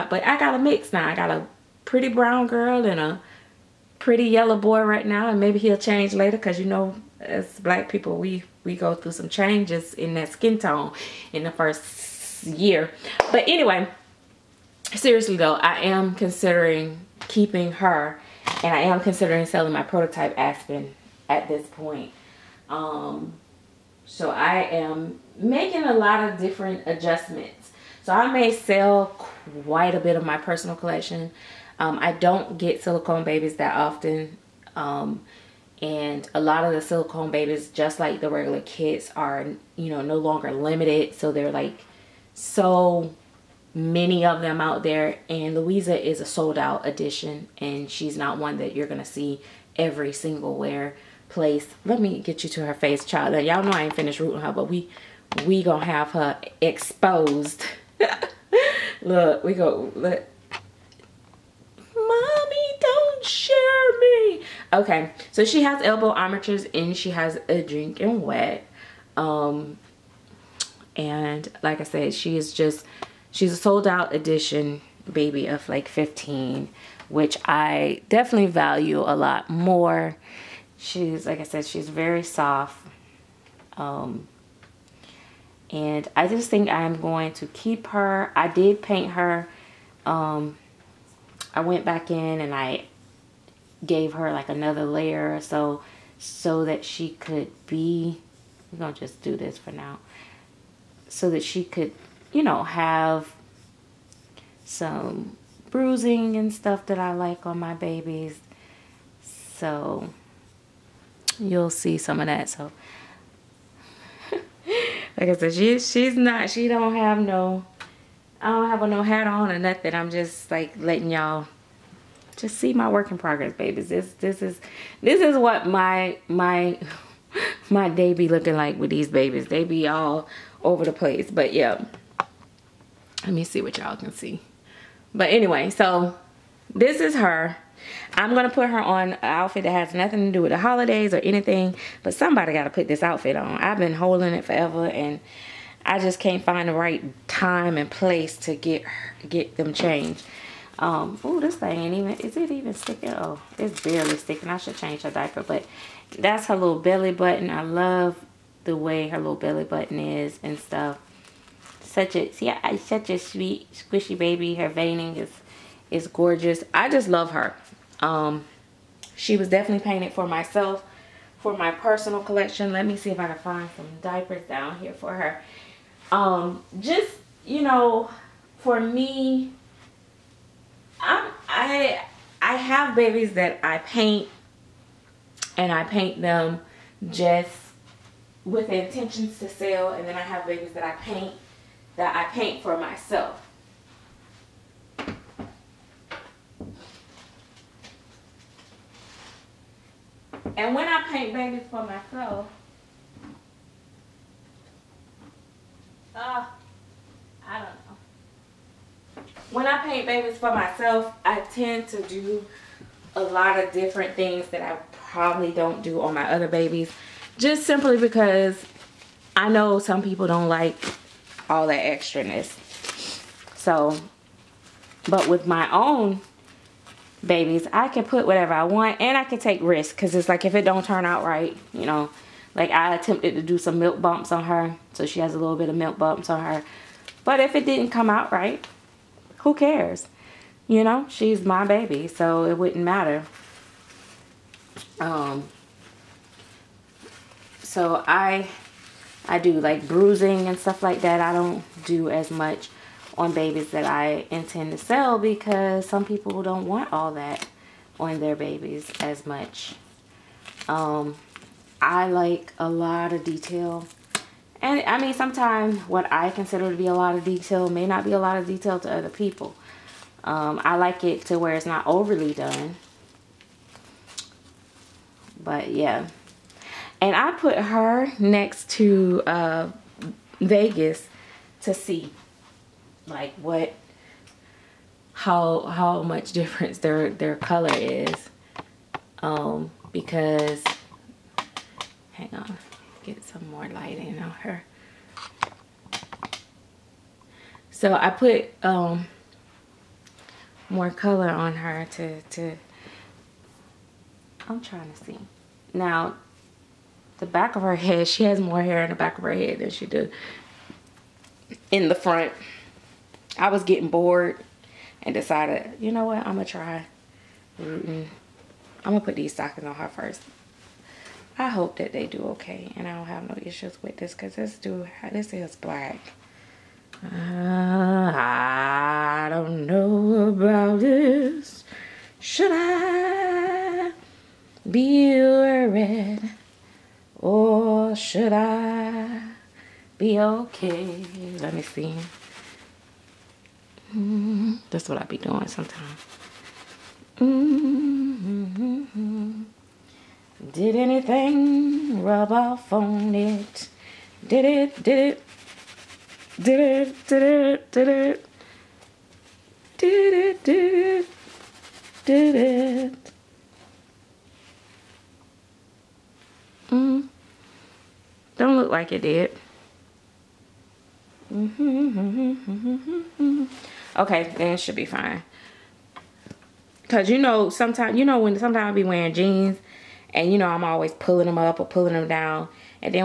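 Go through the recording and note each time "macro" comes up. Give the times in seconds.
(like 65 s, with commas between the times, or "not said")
not said.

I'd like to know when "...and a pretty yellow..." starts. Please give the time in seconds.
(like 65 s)
2 s.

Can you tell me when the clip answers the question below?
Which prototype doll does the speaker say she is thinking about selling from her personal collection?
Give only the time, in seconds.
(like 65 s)
20 s.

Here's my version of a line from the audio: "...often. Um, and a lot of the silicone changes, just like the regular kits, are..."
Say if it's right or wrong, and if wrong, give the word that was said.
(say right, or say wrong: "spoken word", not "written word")
wrong: "babies", not "changes".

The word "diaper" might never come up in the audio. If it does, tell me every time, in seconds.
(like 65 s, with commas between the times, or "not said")
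155 s, 174 s.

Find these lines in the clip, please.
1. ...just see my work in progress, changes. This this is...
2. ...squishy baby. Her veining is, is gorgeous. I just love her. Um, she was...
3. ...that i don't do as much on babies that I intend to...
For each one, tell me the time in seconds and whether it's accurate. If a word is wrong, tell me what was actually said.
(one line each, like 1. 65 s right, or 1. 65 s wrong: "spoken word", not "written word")
1. 122 s wrong: "babies", not "changes"
2. 163 s right
3. 251 s right.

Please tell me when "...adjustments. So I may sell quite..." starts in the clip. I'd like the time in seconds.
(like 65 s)
26 s.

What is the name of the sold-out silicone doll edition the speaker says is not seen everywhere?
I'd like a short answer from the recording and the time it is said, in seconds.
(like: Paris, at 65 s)
Louisa, at 45 s.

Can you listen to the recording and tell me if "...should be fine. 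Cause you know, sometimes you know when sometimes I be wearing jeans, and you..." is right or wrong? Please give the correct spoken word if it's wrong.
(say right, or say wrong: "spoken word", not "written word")
right.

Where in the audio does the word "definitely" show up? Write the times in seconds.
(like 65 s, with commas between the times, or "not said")
78 s, 169 s.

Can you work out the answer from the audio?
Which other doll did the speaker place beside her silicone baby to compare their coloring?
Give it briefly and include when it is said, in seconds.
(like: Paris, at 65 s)
Vegas, at 280 s.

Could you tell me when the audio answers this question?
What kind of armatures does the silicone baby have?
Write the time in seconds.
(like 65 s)
65 s.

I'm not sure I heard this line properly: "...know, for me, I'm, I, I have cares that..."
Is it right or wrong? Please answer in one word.
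wrong.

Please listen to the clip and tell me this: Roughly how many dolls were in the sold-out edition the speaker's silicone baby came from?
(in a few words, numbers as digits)
15.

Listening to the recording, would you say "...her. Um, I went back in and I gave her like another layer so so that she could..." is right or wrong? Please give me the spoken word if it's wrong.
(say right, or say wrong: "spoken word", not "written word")
right.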